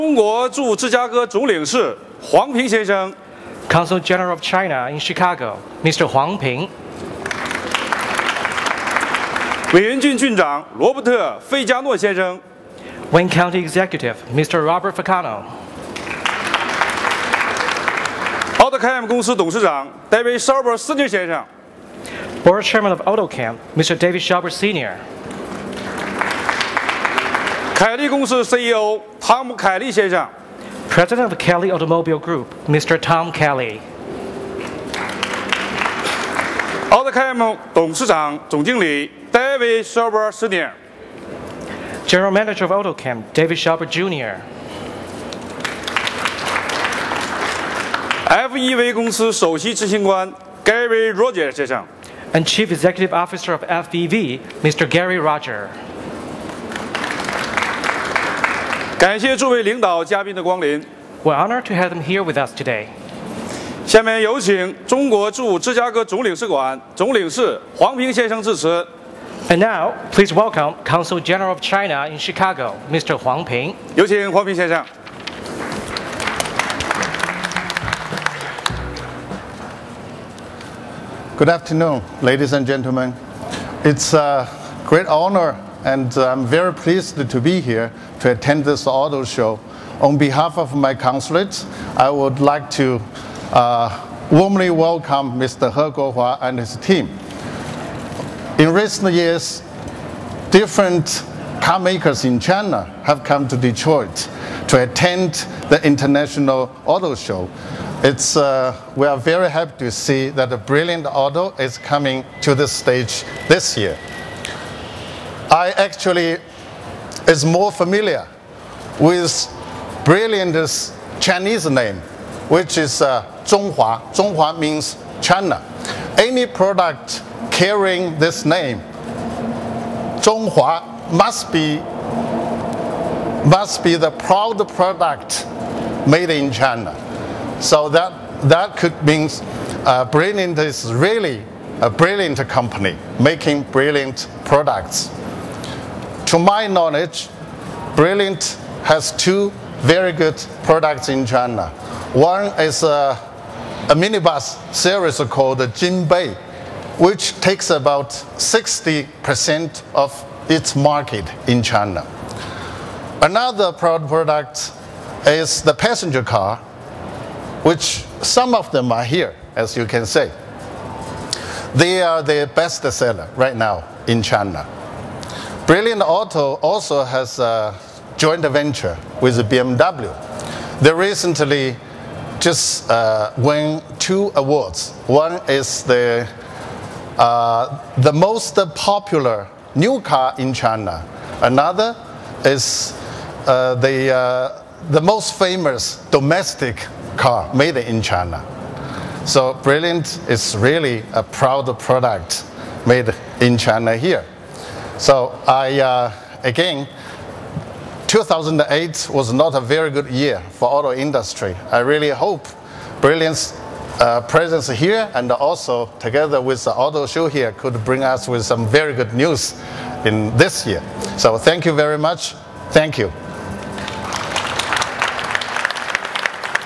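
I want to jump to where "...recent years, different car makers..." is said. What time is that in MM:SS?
01:38.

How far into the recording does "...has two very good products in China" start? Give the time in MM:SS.
02:28.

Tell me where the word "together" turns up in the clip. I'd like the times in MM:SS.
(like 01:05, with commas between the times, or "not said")
03:35.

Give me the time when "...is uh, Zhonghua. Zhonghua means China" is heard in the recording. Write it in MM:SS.
02:02.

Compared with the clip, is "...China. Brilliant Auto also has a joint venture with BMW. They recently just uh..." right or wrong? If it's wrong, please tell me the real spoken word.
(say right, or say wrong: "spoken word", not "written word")
right.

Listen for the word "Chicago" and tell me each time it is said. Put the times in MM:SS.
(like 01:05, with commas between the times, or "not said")
00:04, 01:12.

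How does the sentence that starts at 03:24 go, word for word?
So I, uh, again, 2008 was not a very good year for auto industry.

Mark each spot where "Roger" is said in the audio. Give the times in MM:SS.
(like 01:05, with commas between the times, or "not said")
00:51, 00:55.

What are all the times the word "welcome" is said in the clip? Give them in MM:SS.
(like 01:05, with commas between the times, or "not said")
01:10, 01:34.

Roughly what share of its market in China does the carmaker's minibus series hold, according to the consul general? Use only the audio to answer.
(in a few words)
60%.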